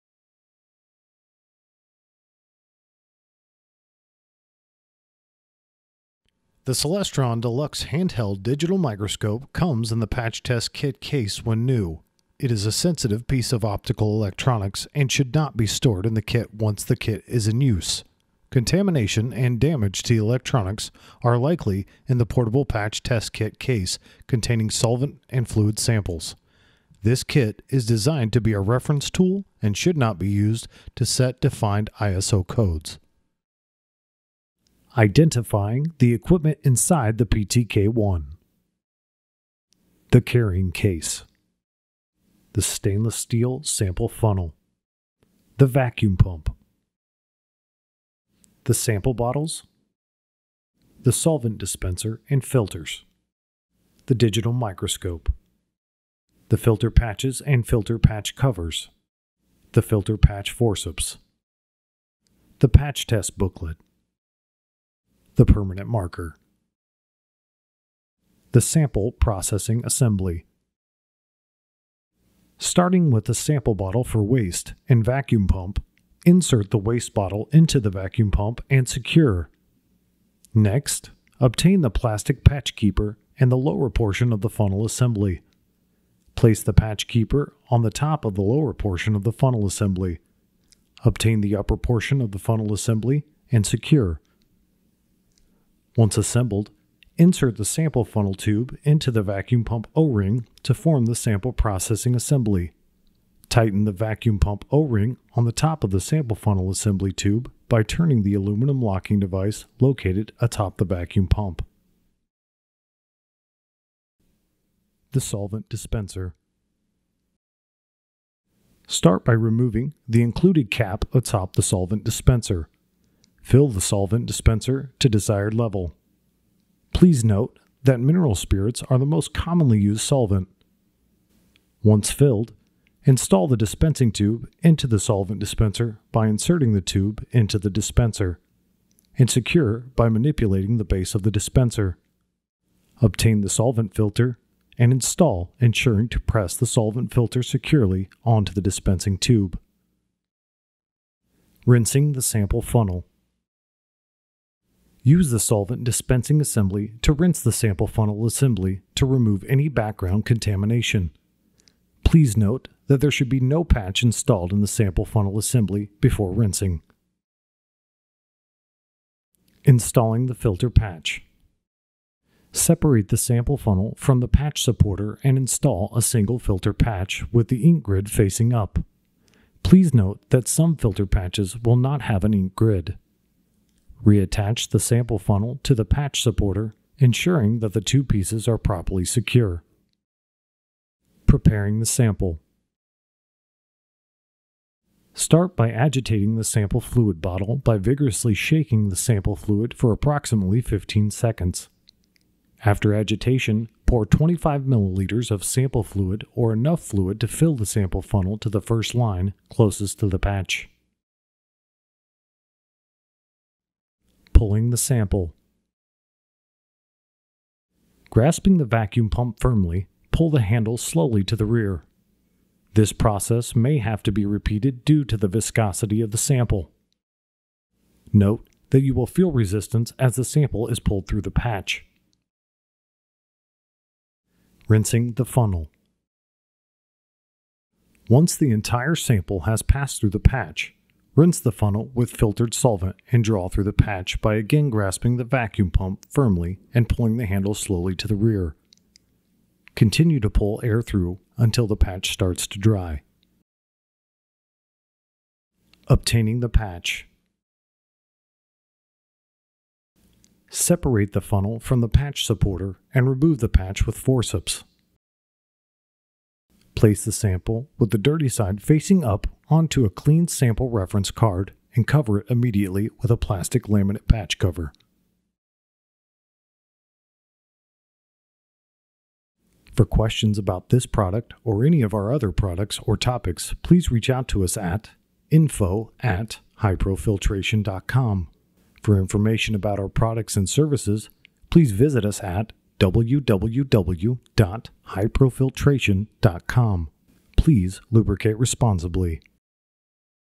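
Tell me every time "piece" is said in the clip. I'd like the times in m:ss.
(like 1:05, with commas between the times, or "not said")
0:13, 3:08.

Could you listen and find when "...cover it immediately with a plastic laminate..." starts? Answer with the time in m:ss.
4:31.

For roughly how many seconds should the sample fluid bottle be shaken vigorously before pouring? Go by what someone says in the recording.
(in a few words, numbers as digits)
15 seconds.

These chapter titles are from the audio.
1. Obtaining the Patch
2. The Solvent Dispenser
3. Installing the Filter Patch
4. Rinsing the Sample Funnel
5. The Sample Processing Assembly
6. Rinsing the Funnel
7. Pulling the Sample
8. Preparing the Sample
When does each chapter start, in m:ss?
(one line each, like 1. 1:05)
1. 4:16
2. 1:54
3. 2:49
4. 2:32
5. 1:09
6. 3:54
7. 3:34
8. 3:11.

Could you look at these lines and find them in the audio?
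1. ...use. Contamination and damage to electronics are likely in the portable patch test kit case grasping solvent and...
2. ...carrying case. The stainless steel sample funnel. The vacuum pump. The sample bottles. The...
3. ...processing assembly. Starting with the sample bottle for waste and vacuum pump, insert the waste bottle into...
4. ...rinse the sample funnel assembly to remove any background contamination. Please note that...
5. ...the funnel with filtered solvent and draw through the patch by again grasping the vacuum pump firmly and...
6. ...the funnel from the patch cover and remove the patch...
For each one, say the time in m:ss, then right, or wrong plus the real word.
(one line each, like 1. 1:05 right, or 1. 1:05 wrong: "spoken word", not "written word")
1. 0:17 wrong: "containing", not "grasping"
2. 0:40 right
3. 1:09 right
4. 2:37 right
5. 4:01 right
6. 4:21 wrong: "supporter", not "cover".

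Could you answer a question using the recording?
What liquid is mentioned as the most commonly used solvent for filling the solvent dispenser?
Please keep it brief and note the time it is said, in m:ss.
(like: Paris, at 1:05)
Mineral spirits, at 2:07.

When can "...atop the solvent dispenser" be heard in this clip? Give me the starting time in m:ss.
2:01.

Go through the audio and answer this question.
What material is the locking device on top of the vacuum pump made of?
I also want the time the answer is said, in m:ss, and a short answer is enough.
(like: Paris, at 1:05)
Aluminum, at 1:48.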